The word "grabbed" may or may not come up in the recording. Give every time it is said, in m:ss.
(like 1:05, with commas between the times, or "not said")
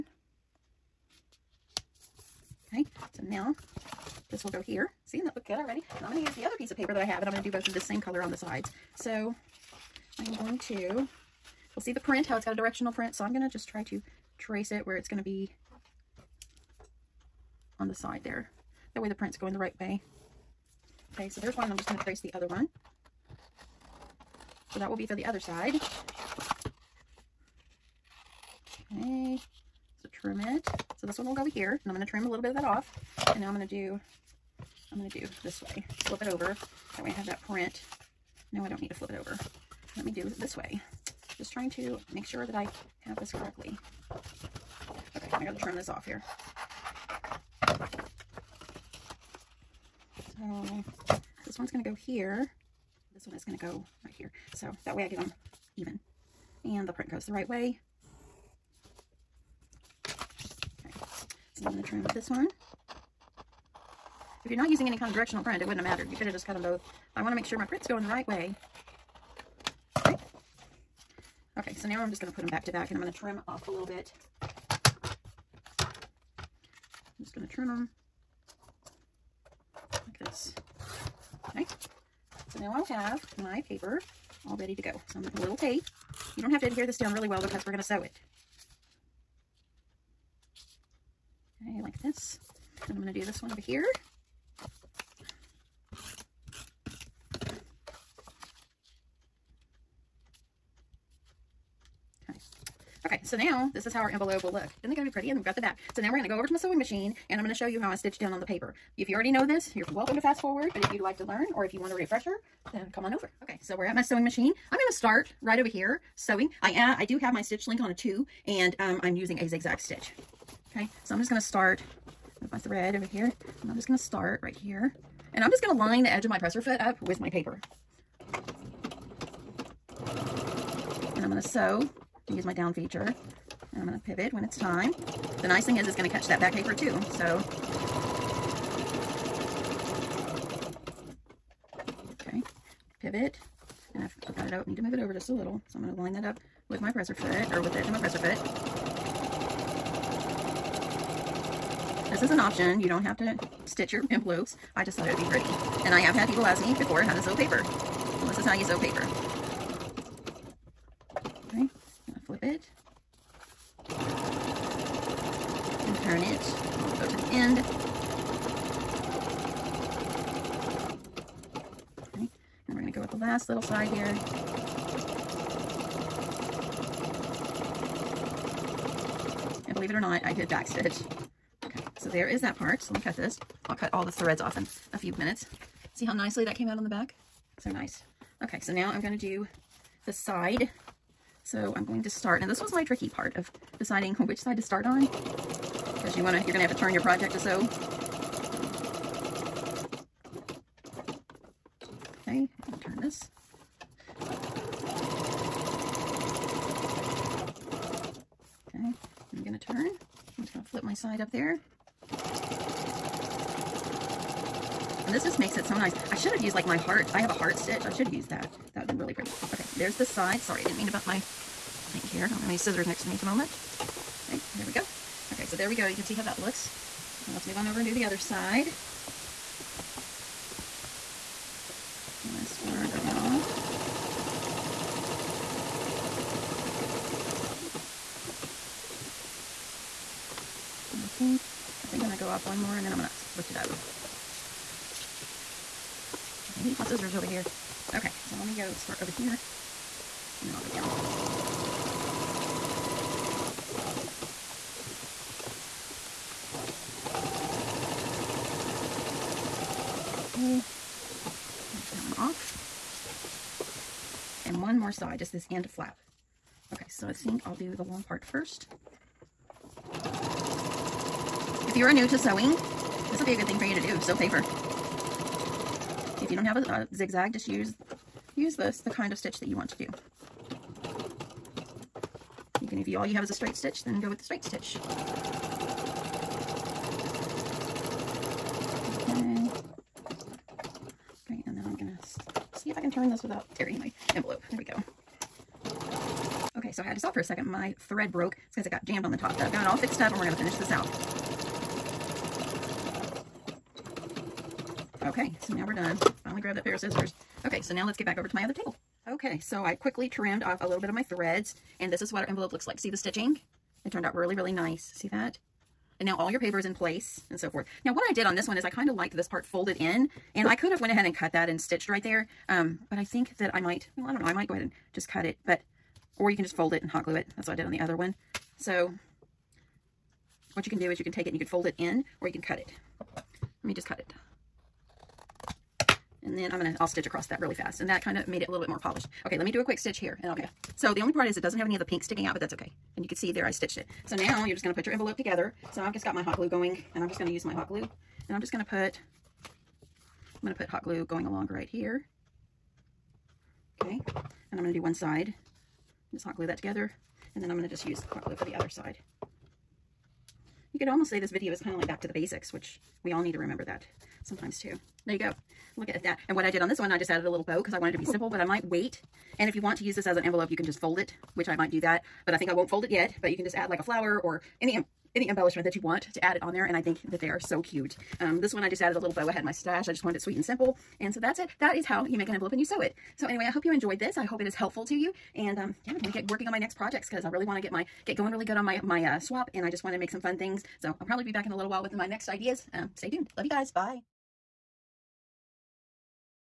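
5:06.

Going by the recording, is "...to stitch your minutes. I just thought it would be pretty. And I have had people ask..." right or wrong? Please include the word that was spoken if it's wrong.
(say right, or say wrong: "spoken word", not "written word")
wrong: "envelopes", not "minutes".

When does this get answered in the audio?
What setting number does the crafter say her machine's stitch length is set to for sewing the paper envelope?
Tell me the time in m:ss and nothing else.
1:57.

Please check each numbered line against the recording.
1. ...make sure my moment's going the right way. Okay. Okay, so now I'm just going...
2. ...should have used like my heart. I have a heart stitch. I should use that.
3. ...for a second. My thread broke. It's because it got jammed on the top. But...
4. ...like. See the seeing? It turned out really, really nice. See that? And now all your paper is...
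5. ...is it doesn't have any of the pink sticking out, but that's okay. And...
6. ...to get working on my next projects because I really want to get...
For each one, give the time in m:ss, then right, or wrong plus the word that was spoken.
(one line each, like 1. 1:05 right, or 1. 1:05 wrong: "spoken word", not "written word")
1. 1:07 wrong: "print", not "moment"
2. 3:36 right
3. 4:57 right
4. 5:12 wrong: "stitching", not "seeing"
5. 5:41 right
6. 6:26 right.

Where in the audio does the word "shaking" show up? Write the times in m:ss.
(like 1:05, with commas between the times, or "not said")
not said.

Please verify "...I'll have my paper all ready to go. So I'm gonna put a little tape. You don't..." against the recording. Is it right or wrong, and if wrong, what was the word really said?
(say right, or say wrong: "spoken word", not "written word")
right.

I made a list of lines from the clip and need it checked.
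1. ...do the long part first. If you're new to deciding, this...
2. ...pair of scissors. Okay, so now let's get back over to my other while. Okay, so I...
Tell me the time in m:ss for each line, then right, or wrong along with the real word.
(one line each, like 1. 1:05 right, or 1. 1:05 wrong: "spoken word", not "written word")
1. 4:27 wrong: "sewing", not "deciding"
2. 5:06 wrong: "table", not "while".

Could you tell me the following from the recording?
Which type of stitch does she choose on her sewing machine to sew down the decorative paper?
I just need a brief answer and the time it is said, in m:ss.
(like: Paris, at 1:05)
zigzag stitch, at 1:59.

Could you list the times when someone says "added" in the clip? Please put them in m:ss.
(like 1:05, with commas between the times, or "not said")
6:07, 6:18.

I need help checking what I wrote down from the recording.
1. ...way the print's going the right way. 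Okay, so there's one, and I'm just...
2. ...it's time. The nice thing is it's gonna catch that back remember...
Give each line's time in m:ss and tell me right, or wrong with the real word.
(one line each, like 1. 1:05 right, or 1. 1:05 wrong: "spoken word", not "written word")
1. 0:18 right
2. 2:14 wrong: "paper", not "remember".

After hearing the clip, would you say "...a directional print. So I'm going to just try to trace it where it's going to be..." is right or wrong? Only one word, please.
right.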